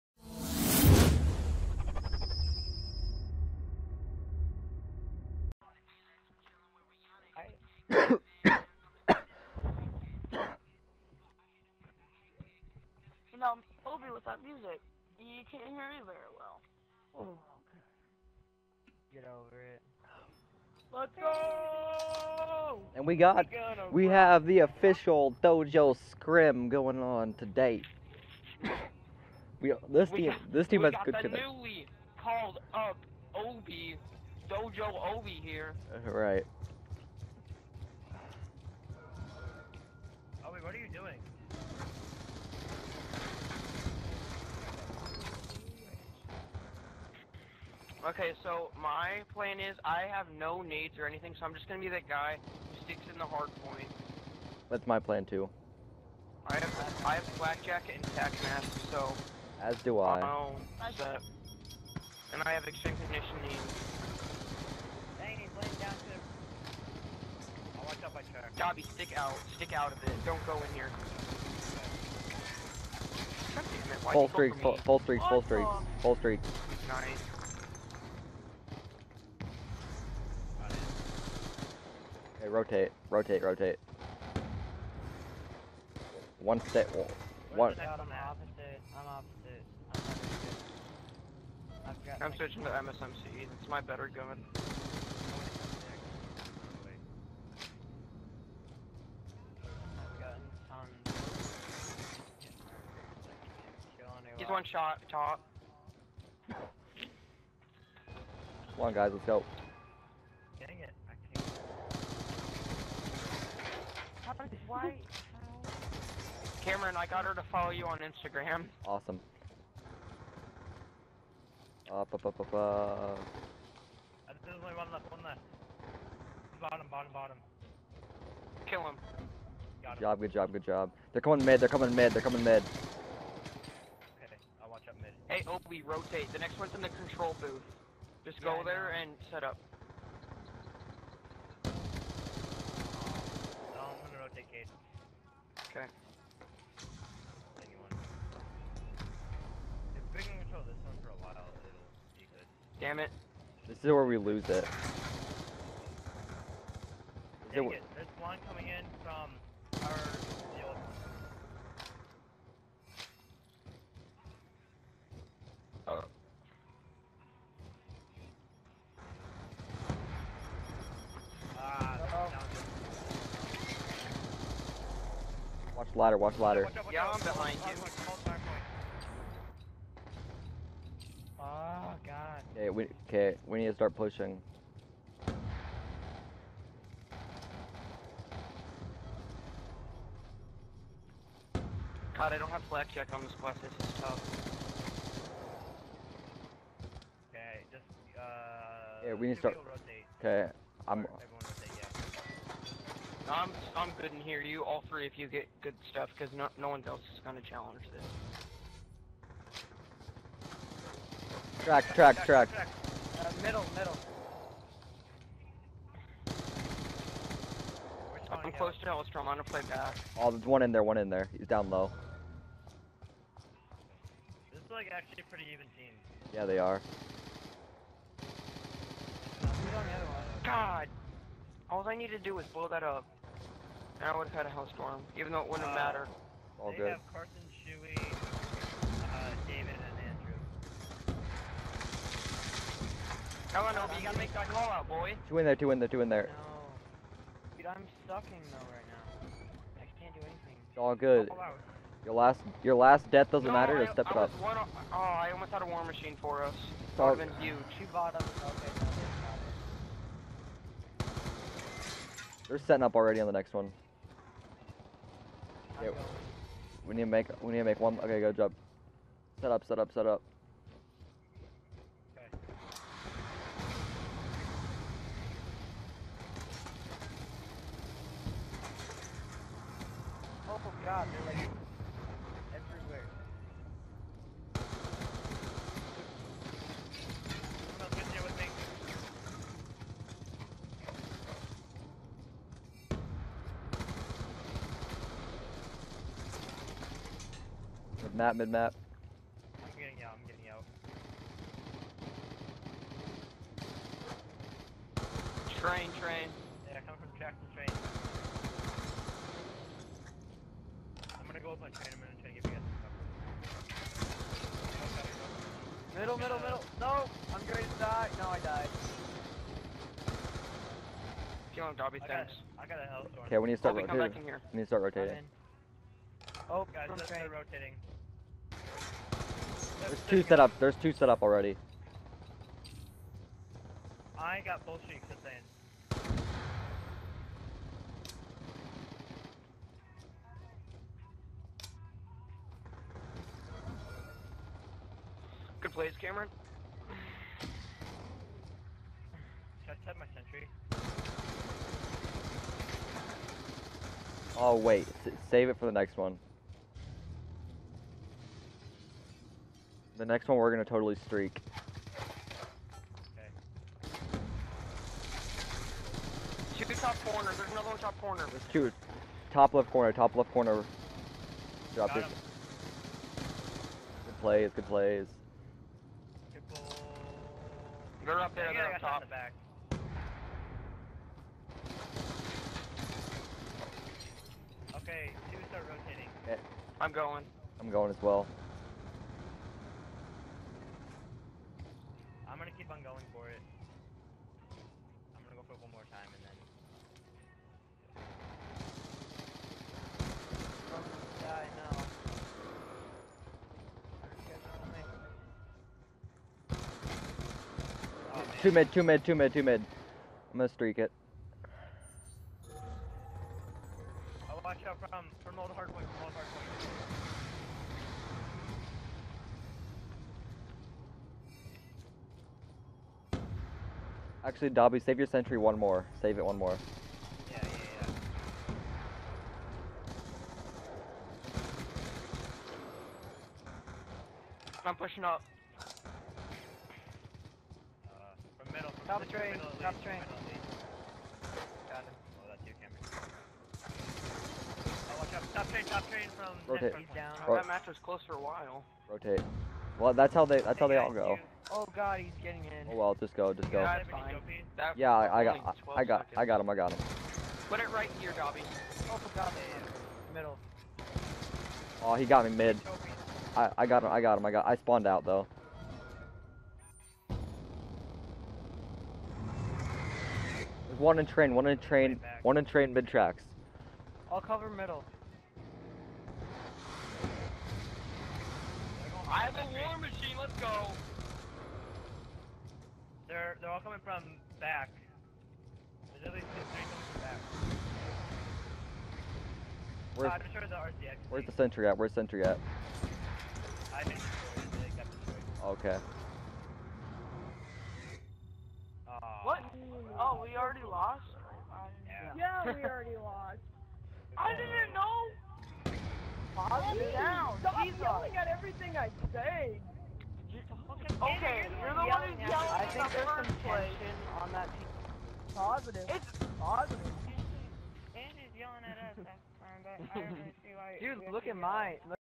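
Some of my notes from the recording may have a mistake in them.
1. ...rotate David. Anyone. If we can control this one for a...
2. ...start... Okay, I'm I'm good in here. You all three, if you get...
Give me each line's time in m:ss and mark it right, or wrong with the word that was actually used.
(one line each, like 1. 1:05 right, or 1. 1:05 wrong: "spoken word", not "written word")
1. 2:24 wrong: "Okay", not "David"
2. 3:19 right.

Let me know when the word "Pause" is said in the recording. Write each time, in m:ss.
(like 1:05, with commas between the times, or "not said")
8:26.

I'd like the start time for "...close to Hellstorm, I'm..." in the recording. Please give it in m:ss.
3:38.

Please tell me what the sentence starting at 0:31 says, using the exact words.
We got the newly called up Obi, Dojo Obi here.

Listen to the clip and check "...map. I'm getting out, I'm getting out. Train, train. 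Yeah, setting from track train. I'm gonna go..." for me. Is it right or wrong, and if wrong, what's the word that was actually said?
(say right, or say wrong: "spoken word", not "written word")
wrong: "coming", not "setting".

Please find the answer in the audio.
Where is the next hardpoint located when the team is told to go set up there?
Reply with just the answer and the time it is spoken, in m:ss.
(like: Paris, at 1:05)
Control booth, at 2:16.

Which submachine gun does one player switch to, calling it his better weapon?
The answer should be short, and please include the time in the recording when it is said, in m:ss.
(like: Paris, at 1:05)
MSMC, at 1:32.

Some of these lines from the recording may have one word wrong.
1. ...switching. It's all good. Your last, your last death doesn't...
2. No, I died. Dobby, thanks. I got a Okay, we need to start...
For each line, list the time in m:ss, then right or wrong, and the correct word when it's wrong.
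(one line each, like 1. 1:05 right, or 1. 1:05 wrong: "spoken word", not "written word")
1. 4:10 wrong: "anything", not "switching"
2. 5:18 right.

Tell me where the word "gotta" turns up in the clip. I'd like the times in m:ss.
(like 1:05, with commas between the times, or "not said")
4:04.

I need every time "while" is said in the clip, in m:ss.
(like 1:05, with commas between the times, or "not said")
2:31, 7:28.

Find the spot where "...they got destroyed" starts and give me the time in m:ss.
8:13.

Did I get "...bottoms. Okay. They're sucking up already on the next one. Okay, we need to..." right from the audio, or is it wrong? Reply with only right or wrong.
wrong.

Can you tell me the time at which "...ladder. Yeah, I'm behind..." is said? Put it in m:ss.
2:56.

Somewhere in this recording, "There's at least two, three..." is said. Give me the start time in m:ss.
8:05.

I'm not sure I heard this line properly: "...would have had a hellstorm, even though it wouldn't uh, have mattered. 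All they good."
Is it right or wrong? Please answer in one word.
right.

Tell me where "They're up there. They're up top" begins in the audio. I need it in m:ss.
6:18.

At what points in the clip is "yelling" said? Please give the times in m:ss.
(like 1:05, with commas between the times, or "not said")
8:27, 8:32, 8:38.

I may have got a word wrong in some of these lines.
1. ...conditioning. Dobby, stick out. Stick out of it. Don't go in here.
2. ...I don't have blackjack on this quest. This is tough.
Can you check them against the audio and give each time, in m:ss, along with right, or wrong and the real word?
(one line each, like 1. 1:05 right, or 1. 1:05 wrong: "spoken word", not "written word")
1. 1:03 right
2. 3:12 right.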